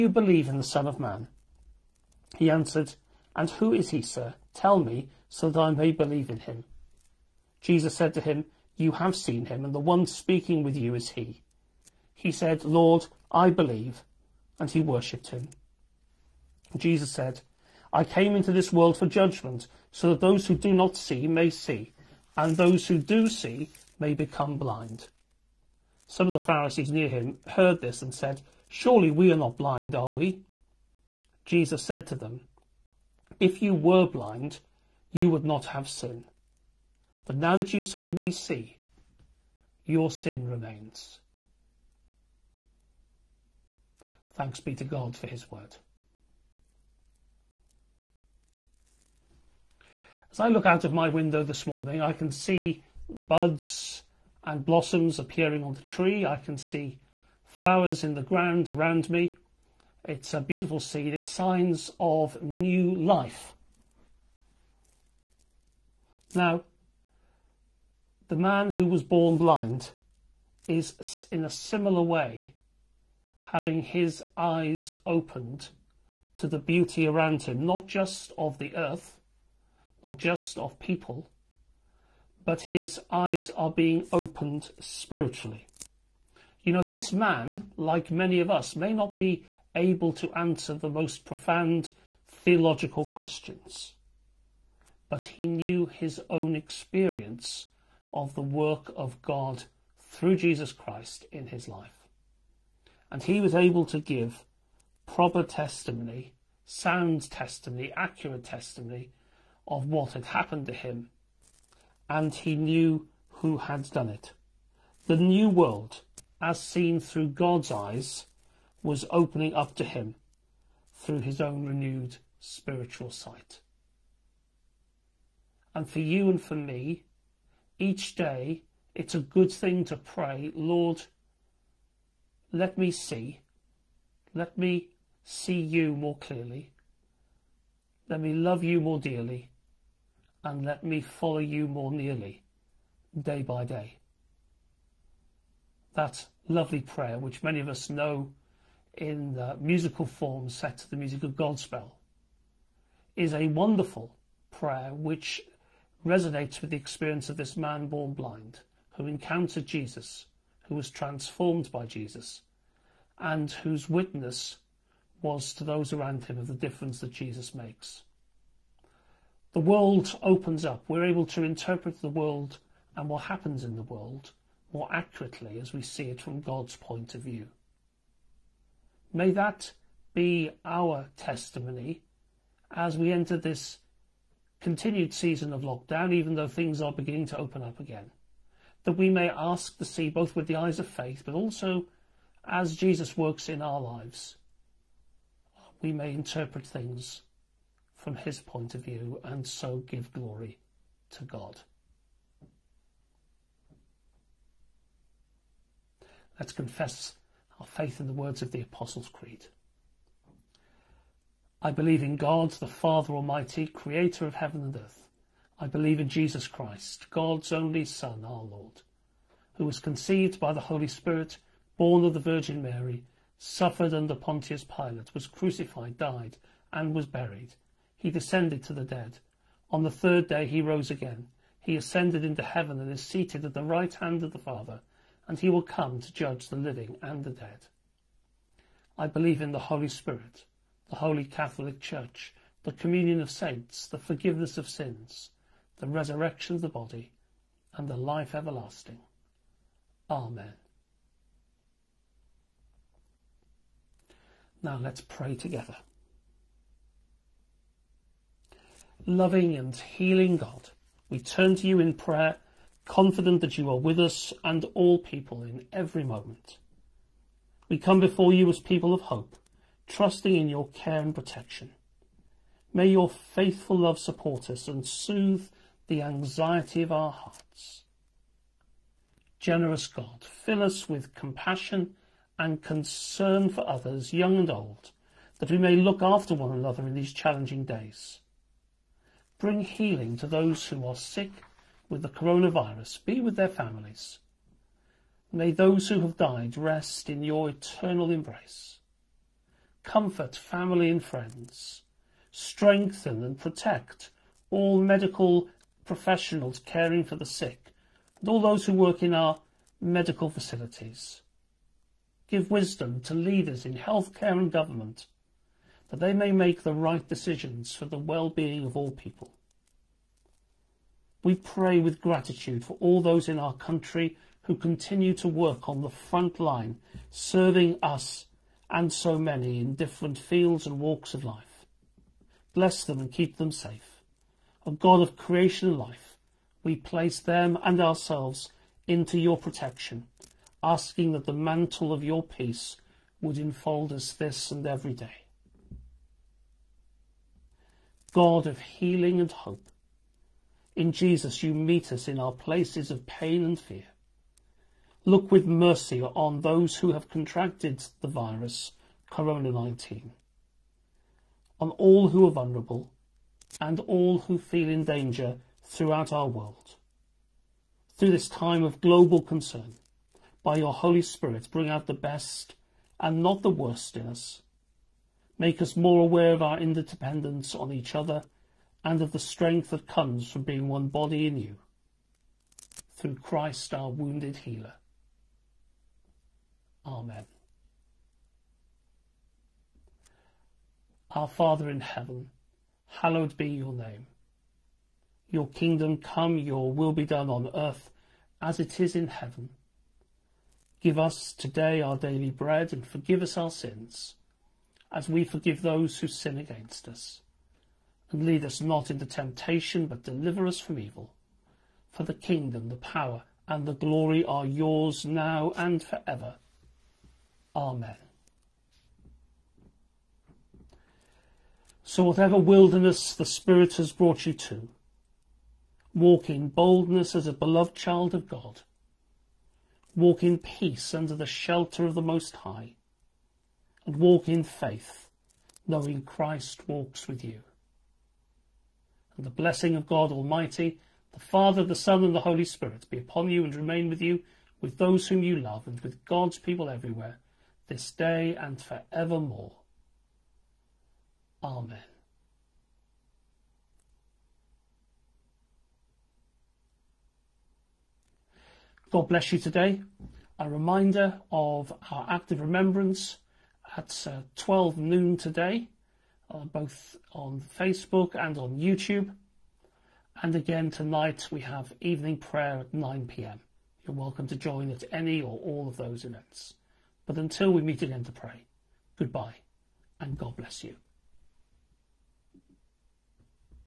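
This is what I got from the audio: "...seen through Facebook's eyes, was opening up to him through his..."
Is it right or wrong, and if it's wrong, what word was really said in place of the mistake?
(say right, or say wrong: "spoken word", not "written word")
wrong: "God", not "Facebook".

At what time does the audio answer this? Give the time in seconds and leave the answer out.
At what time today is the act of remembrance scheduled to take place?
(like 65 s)
464 s.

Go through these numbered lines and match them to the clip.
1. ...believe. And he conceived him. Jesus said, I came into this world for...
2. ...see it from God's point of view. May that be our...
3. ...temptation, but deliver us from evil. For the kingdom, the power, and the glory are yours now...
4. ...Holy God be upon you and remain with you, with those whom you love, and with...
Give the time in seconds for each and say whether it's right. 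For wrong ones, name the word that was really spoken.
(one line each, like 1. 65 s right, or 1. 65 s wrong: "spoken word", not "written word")
1. 13 s wrong: "worshipped", not "conceived"
2. 175 s right
3. 409 s right
4. 442 s wrong: "Spirit", not "God".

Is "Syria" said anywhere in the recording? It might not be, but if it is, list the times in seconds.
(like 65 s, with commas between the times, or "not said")
not said.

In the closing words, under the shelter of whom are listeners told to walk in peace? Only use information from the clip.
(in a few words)
The Most High.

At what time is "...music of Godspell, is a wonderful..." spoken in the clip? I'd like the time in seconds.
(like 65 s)
150 s.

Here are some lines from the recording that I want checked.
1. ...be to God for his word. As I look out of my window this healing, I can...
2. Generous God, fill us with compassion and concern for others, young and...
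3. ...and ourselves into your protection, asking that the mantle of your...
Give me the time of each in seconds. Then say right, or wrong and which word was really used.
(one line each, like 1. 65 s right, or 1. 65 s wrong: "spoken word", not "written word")
1. 44 s wrong: "morning", not "healing"
2. 279 s right
3. 337 s right.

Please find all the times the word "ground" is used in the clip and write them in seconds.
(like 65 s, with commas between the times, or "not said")
58 s.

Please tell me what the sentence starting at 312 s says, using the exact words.
Give wisdom to leaders in healthcare and government, that they may make the right decisions for the well-being of all people.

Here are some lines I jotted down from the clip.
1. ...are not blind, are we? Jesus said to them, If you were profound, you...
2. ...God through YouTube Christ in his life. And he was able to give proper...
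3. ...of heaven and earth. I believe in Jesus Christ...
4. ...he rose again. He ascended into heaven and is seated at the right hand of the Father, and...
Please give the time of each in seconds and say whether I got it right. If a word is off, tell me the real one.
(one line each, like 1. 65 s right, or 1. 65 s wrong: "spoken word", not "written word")
1. 29 s wrong: "blind", not "profound"
2. 99 s wrong: "Jesus", not "YouTube"
3. 214 s right
4. 230 s right.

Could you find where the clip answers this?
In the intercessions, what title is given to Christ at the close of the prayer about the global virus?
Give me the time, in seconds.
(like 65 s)
383 s.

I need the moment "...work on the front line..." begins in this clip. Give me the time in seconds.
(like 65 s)
325 s.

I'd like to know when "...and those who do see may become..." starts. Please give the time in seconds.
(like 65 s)
22 s.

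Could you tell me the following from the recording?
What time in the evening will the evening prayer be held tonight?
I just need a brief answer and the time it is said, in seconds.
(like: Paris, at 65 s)
9 pm, at 472 s.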